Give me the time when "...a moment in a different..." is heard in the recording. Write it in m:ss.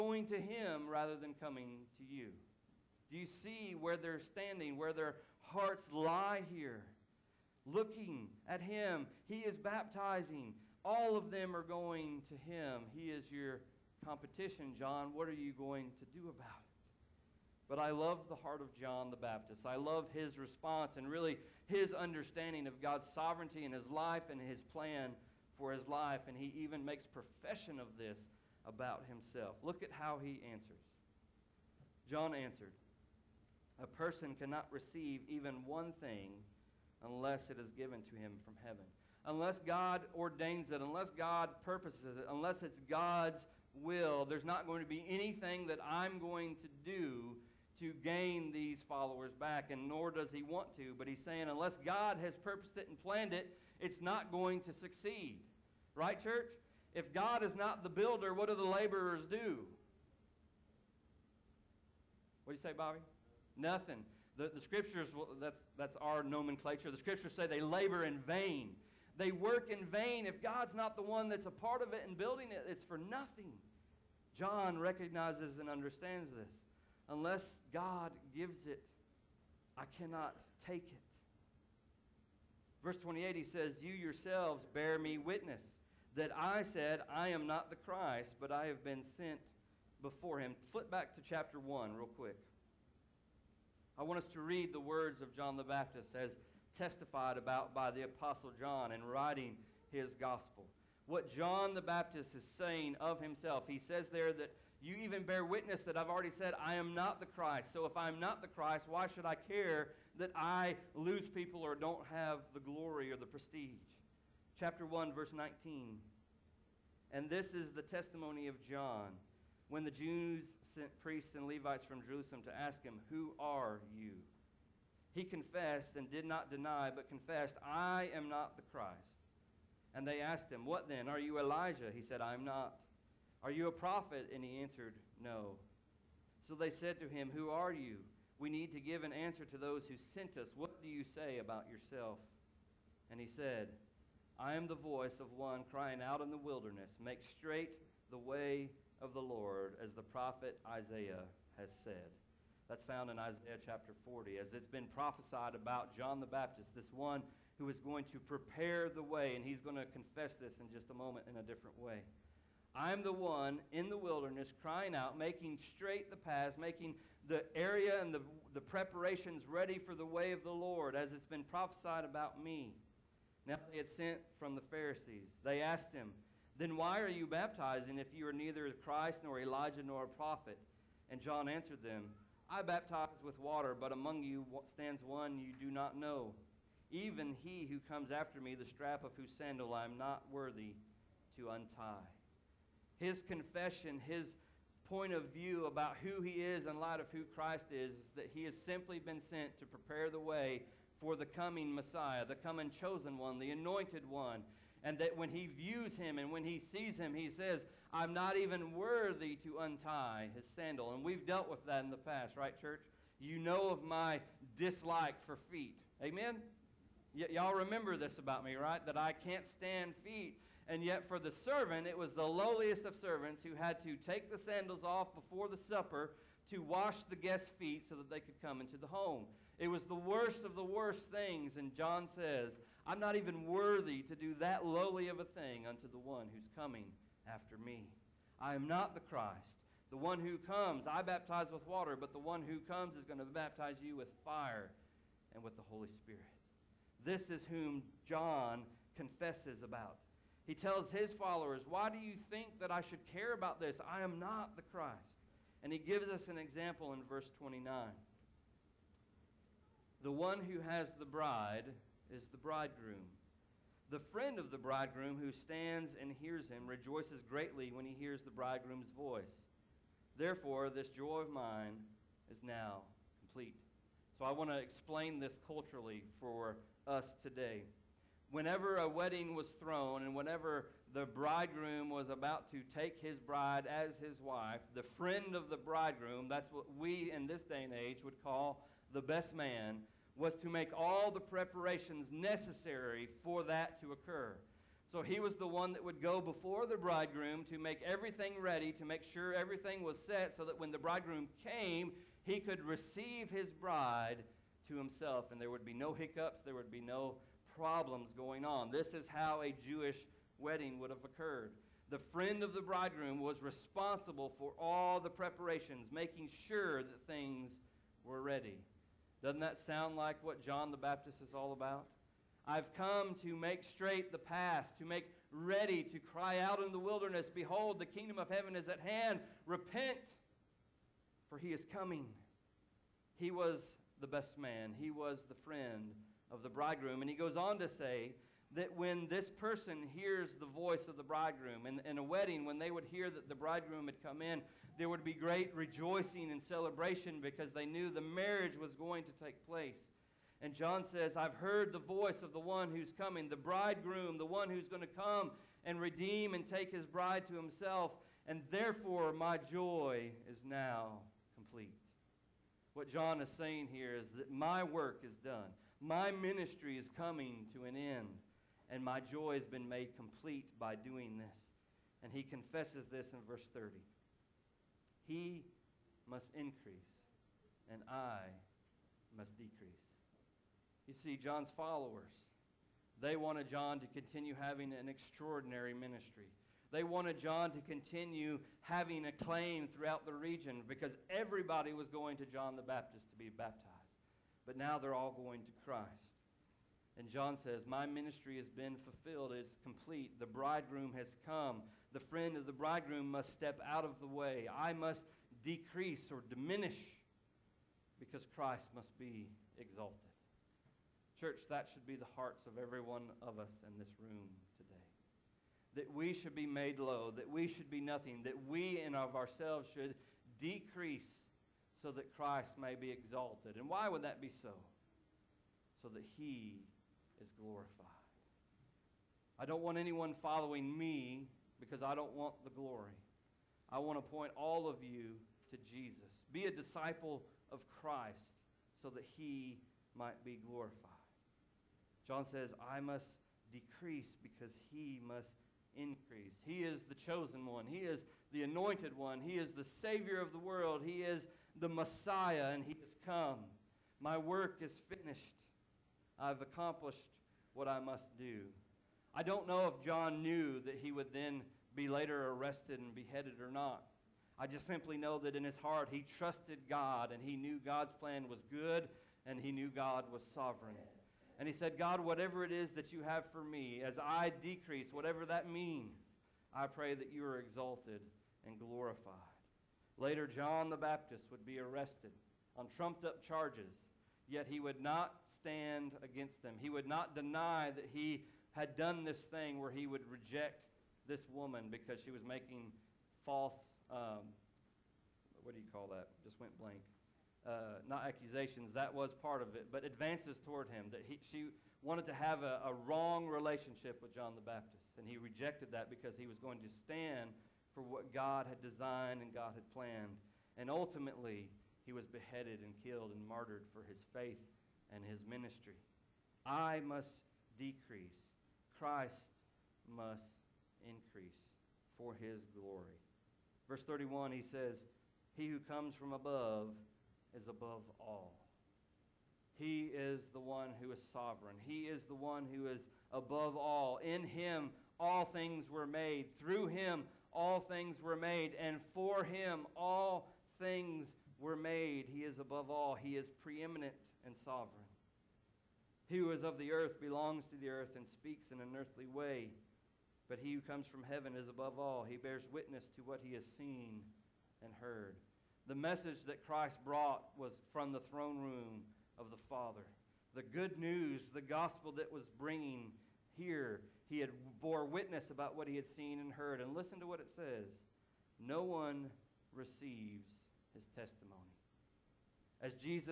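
2:40.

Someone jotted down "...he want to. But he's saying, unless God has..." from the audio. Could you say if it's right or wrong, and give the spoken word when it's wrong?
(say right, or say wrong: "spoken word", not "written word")
right.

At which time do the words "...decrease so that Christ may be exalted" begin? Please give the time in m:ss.
7:00.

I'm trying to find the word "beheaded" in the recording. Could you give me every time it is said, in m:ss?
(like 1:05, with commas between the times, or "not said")
7:42, 8:32.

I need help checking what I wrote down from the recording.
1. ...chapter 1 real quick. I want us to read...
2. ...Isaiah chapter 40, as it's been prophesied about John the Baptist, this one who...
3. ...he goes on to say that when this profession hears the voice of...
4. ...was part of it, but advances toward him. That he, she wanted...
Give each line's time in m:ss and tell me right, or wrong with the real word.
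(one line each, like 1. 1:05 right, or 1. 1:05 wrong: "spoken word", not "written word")
1. 1:31 right
2. 2:33 right
3. 5:37 wrong: "person", not "profession"
4. 8:18 right.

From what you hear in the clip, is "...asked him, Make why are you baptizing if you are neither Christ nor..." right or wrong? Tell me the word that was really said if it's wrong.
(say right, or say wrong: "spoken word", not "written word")
wrong: "Then", not "Make".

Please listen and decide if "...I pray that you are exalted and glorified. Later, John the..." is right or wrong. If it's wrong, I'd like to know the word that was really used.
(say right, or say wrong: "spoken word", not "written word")
right.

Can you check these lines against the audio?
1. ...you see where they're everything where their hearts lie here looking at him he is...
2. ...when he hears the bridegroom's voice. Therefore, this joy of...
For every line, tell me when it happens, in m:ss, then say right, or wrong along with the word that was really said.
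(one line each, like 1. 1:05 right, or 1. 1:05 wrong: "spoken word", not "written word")
1. 0:03 wrong: "standing", not "everything"
2. 4:27 right.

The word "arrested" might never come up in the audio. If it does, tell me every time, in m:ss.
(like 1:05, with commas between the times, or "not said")
7:42, 8:01.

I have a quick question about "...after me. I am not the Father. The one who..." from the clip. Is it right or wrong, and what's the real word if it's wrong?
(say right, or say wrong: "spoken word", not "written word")
wrong: "Christ", not "Father".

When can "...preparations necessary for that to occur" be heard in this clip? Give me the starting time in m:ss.
4:51.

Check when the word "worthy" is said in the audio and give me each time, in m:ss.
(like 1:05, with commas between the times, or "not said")
3:10, 3:28, 3:53.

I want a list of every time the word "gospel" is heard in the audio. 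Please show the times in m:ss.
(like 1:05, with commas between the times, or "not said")
1:40, 9:21.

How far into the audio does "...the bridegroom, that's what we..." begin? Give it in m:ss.
4:45.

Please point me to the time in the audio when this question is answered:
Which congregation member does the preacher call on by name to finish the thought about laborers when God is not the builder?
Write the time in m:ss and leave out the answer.
1:02.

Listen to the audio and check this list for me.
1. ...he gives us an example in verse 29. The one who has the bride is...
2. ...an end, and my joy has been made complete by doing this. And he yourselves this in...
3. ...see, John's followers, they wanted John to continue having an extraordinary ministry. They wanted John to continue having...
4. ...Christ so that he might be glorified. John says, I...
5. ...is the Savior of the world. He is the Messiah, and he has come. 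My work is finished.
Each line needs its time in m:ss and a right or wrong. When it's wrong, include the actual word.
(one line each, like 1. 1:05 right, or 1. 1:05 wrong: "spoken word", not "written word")
1. 4:15 right
2. 6:07 wrong: "confesses", not "yourselves"
3. 6:21 right
4. 7:17 right
5. 7:29 right.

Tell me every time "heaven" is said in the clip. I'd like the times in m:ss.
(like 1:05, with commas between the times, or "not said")
0:38, 5:28, 9:11.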